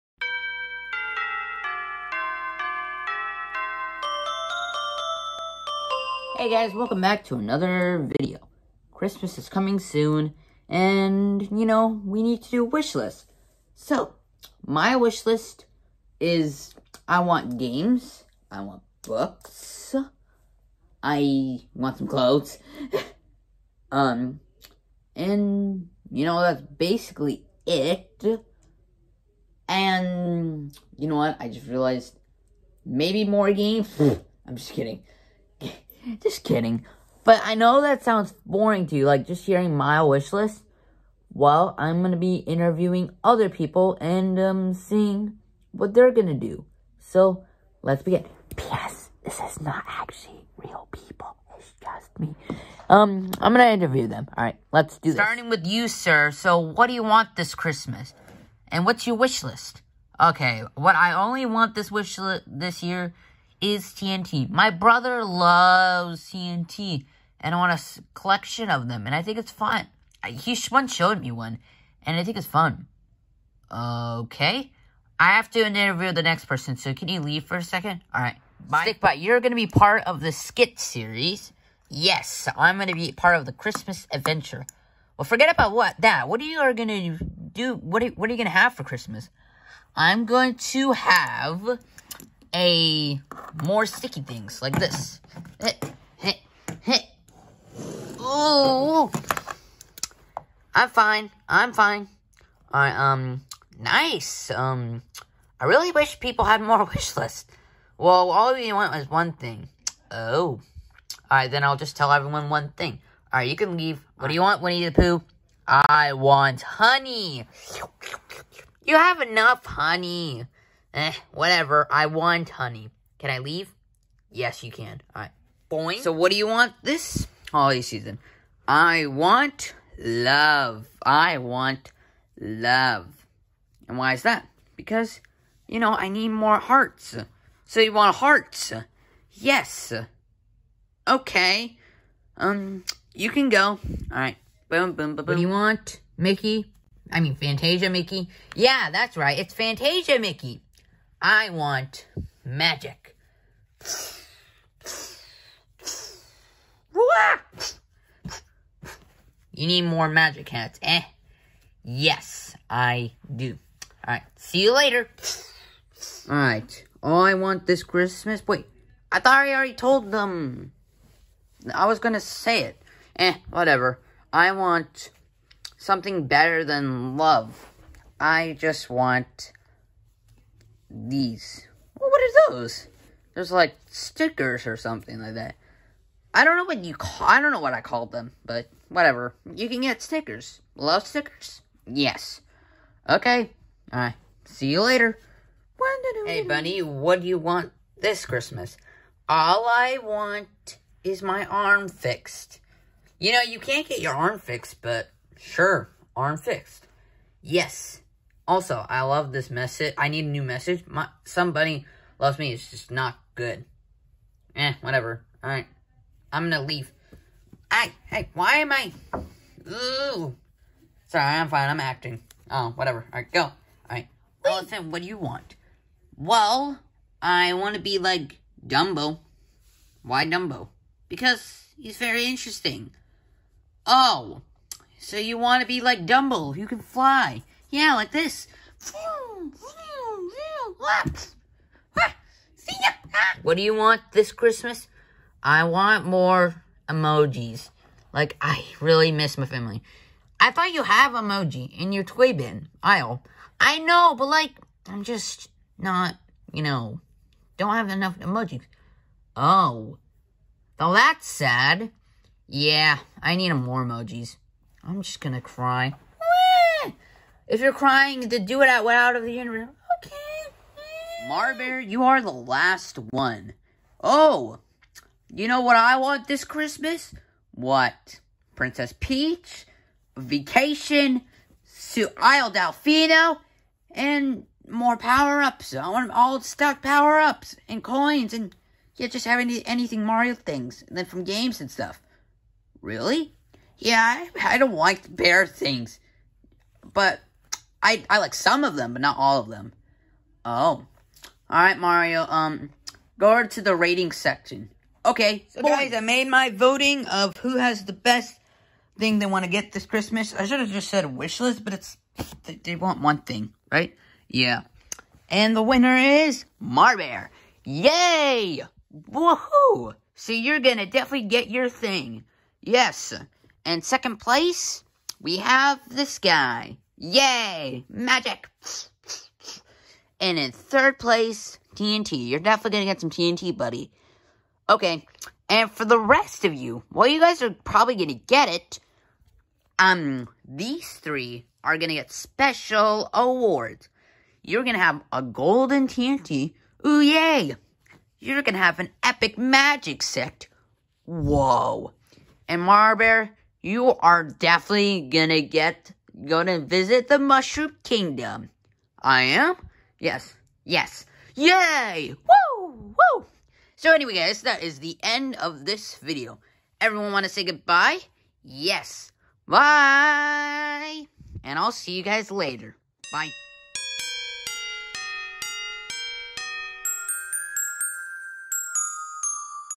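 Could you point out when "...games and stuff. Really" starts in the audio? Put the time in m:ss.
4:51.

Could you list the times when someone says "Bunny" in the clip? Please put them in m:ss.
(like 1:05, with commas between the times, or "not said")
3:16.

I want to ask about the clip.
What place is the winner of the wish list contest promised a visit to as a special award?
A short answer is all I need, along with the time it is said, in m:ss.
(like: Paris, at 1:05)
Mushroom Kingdom, at 5:57.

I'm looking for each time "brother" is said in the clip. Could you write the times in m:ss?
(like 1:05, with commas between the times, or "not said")
1:04.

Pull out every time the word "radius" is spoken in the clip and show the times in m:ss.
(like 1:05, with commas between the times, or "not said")
not said.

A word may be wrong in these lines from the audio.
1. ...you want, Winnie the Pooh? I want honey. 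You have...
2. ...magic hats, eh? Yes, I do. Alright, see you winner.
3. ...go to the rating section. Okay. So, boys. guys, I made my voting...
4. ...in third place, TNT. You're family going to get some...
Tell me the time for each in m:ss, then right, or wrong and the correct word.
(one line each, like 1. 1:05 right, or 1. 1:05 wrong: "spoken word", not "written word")
1. 1:54 right
2. 2:40 wrong: "later", not "winner"
3. 5:03 right
4. 5:30 wrong: "definitely", not "family".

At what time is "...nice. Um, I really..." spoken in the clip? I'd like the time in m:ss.
1:43.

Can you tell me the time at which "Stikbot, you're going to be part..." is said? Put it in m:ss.
1:18.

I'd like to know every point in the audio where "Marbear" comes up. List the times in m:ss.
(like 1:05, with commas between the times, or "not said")
4:31, 5:16, 5:52.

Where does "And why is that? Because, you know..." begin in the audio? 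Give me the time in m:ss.
2:13.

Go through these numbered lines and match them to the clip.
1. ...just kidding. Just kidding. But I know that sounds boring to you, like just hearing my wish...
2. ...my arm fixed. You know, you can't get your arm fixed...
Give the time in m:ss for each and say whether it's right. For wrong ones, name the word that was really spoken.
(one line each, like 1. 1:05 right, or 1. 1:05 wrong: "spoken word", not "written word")
1. 0:34 right
2. 3:21 right.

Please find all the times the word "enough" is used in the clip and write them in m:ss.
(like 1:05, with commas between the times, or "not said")
1:59, 4:17.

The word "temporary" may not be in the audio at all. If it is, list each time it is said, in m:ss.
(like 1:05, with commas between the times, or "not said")
not said.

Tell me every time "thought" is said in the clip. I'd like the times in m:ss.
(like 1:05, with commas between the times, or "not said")
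2:49, 4:10.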